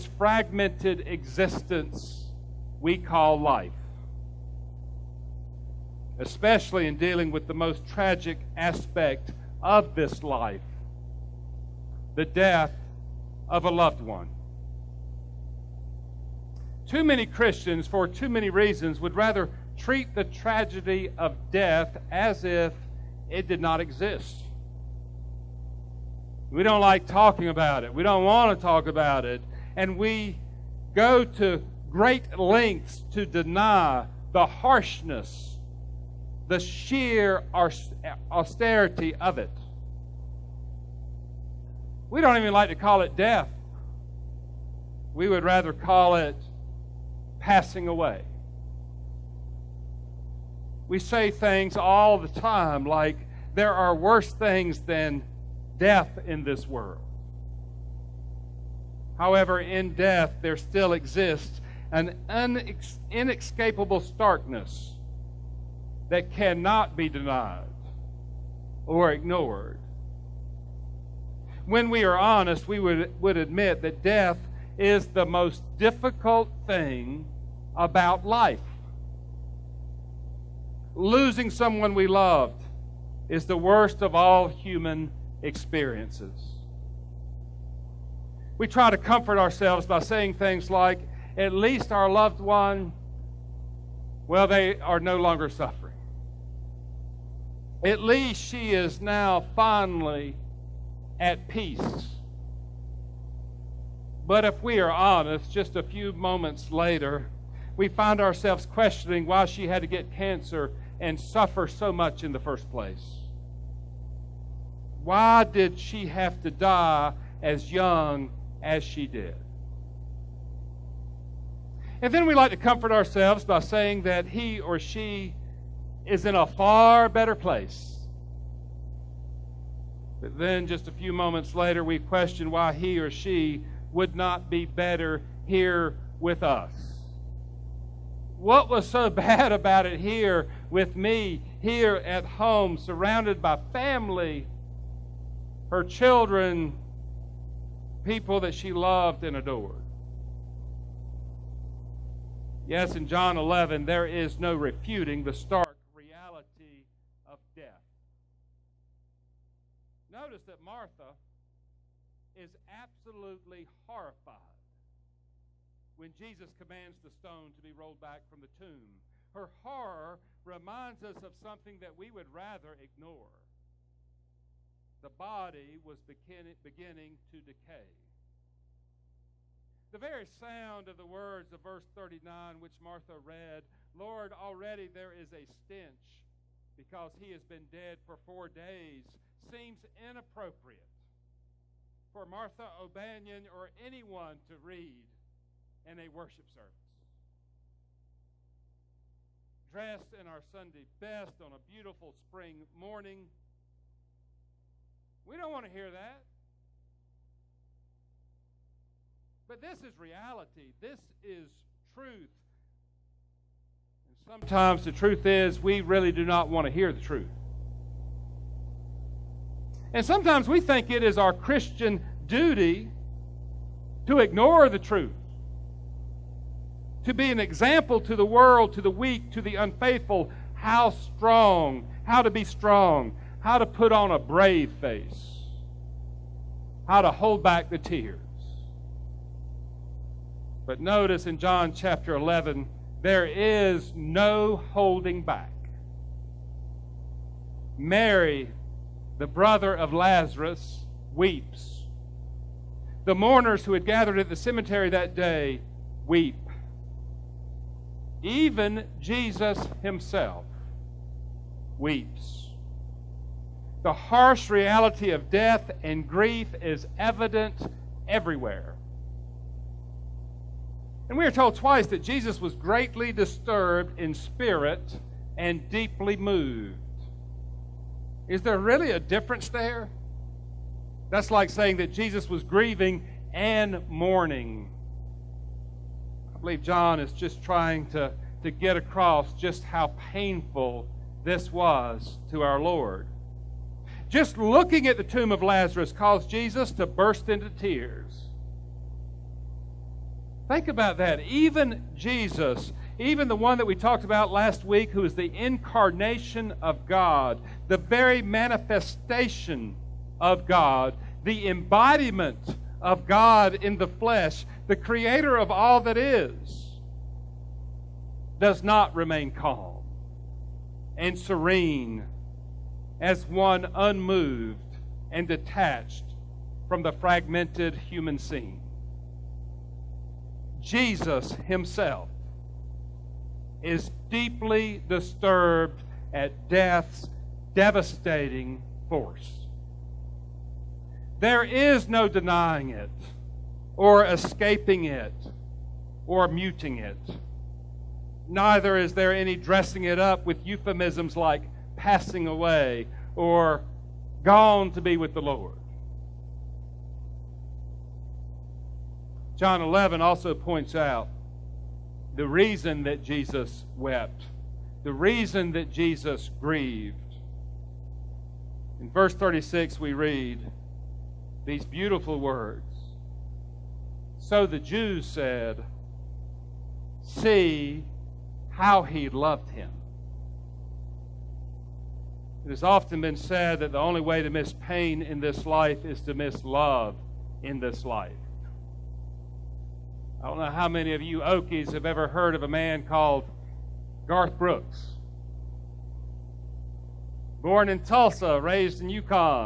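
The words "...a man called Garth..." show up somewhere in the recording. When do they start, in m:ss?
6:32.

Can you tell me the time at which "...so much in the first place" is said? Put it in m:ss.
1:51.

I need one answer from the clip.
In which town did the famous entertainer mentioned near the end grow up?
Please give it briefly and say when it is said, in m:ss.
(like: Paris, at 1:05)
Yukon, at 6:38.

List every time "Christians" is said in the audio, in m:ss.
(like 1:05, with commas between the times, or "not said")
0:17, 3:41.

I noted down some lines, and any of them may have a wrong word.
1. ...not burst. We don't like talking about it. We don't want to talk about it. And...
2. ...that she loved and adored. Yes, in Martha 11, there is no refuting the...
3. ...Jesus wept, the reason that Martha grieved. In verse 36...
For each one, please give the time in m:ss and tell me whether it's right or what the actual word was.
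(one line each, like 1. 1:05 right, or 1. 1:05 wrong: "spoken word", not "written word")
1. 0:23 wrong: "exist", not "burst"
2. 2:28 wrong: "John", not "Martha"
3. 6:03 wrong: "Jesus", not "Martha".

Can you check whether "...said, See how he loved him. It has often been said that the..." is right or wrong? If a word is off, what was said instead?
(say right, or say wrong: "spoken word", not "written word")
right.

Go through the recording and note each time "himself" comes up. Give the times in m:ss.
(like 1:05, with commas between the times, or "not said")
4:19, 5:31.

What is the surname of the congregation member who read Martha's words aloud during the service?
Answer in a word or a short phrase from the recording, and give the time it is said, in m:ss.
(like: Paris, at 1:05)
O'Banion, at 3:12.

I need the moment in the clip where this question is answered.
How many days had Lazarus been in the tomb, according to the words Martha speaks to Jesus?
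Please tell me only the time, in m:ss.
3:08.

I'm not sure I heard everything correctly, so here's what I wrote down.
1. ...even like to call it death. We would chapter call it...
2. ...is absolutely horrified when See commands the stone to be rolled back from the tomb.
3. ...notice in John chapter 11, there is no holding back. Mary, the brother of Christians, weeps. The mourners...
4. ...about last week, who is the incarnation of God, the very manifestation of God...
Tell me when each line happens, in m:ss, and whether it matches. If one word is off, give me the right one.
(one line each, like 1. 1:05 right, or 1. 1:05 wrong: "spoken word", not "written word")
1. 0:42 wrong: "rather", not "chapter"
2. 2:42 wrong: "Jesus", not "See"
3. 4:00 wrong: "Lazarus", not "Christians"
4. 5:04 right.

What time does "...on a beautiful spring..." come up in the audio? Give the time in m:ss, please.
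3:21.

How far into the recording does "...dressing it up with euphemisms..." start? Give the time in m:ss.
5:49.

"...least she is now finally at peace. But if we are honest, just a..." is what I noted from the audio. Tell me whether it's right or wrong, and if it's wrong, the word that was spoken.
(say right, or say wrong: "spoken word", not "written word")
right.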